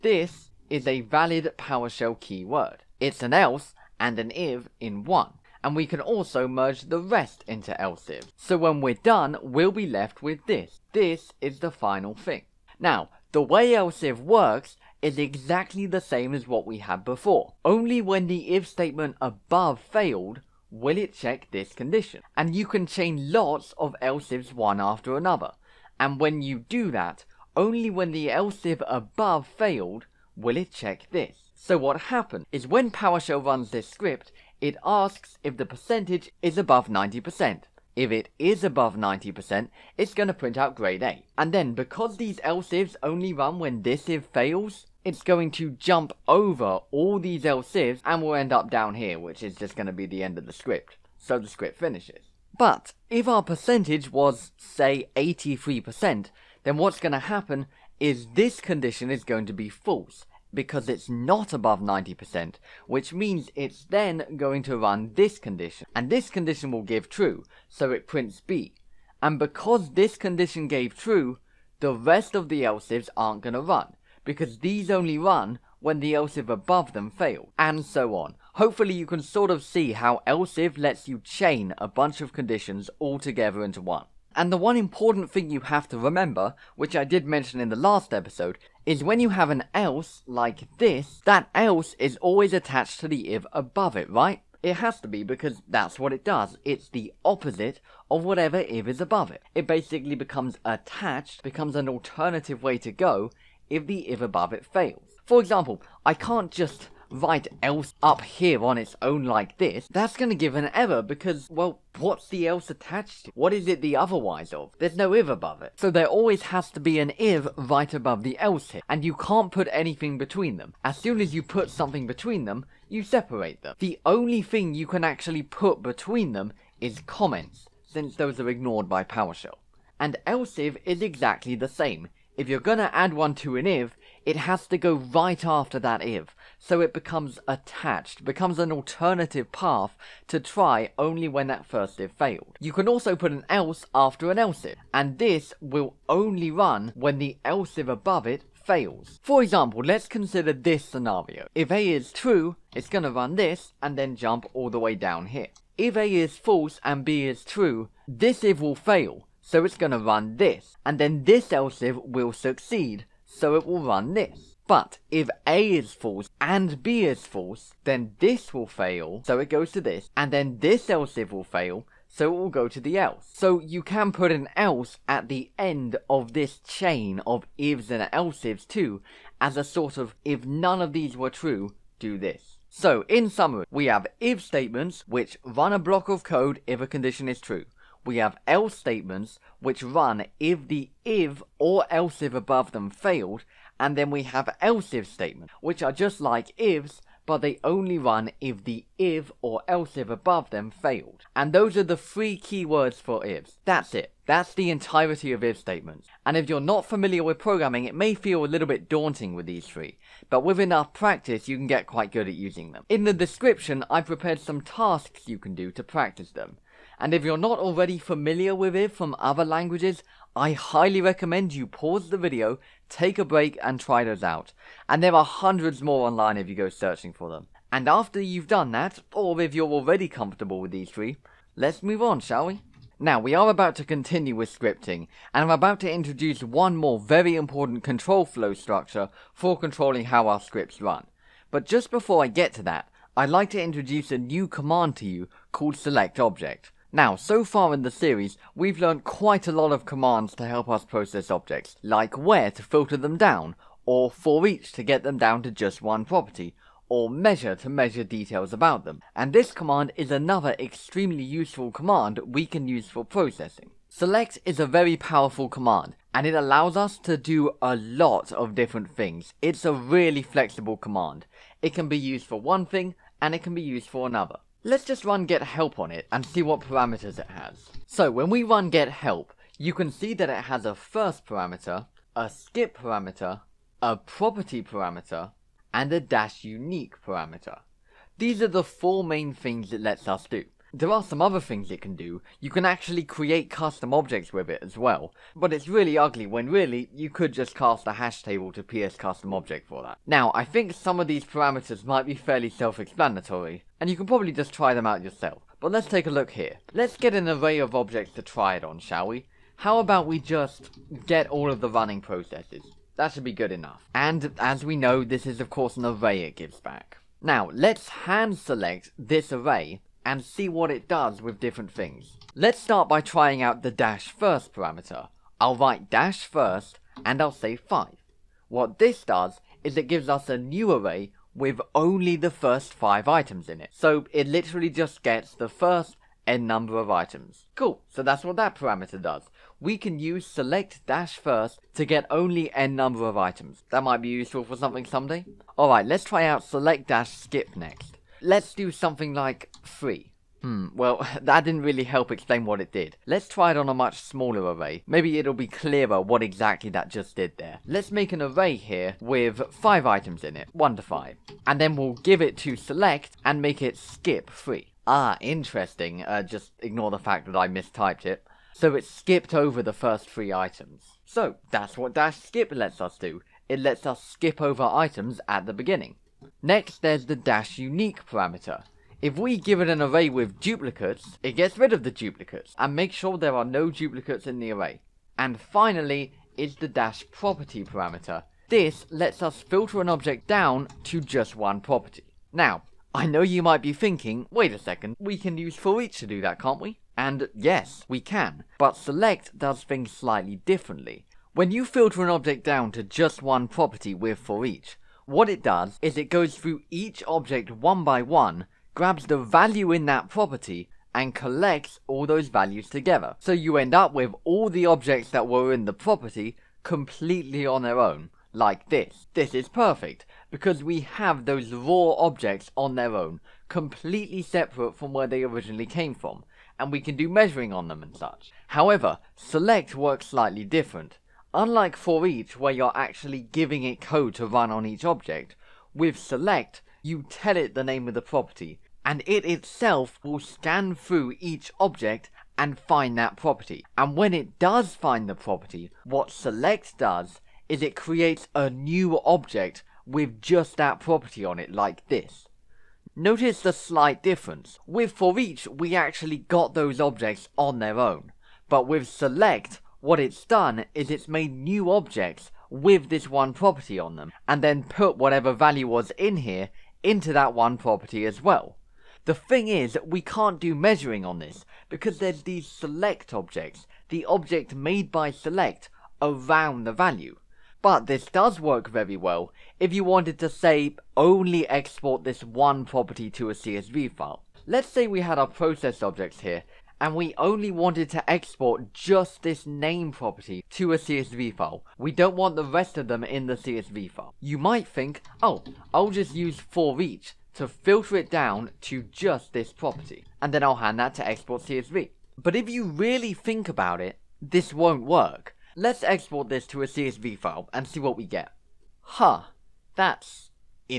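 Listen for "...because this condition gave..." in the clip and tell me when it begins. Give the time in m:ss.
1:09.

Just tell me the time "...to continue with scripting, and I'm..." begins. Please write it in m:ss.
3:53.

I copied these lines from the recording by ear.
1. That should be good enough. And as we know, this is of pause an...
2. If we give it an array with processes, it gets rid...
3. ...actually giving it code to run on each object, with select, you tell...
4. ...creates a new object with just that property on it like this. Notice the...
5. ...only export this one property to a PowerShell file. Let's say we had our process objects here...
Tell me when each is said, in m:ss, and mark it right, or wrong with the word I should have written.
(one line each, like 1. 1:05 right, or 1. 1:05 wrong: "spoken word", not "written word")
1. 5:12 wrong: "course", not "pause"
2. 6:18 wrong: "duplicates", not "processes"
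3. 7:12 right
4. 7:27 right
5. 8:00 wrong: "CSV", not "PowerShell".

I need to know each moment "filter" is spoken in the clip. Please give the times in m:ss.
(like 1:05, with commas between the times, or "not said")
4:12, 6:29, 6:41, 8:17.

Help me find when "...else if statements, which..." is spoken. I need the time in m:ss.
3:14.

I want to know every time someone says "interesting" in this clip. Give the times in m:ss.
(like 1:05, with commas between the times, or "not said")
6:05.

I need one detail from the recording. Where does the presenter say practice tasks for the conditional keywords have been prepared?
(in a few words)
In the description.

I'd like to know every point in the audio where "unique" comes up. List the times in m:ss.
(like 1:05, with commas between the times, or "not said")
4:46, 6:17.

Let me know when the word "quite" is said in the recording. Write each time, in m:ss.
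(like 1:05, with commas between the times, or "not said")
3:31, 4:09.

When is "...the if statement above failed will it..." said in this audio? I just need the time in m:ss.
0:18.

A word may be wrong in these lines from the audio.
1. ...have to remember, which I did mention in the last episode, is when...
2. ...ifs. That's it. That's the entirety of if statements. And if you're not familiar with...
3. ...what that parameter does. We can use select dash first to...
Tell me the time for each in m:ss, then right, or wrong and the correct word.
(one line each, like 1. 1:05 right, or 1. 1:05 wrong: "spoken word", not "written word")
1. 1:25 right
2. 3:23 right
3. 5:38 right.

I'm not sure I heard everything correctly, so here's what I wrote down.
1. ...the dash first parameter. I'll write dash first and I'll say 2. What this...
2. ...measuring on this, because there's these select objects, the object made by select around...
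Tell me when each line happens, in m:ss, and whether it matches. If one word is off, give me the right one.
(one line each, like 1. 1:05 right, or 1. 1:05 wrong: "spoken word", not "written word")
1. 5:23 wrong: "5", not "2"
2. 7:50 right.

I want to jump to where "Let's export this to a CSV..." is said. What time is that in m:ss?
8:25.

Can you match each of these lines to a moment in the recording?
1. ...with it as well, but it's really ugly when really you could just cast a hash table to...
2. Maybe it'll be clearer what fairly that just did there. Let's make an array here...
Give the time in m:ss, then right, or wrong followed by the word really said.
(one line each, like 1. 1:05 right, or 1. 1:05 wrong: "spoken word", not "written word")
1. 4:54 right
2. 5:54 wrong: "exactly", not "fairly".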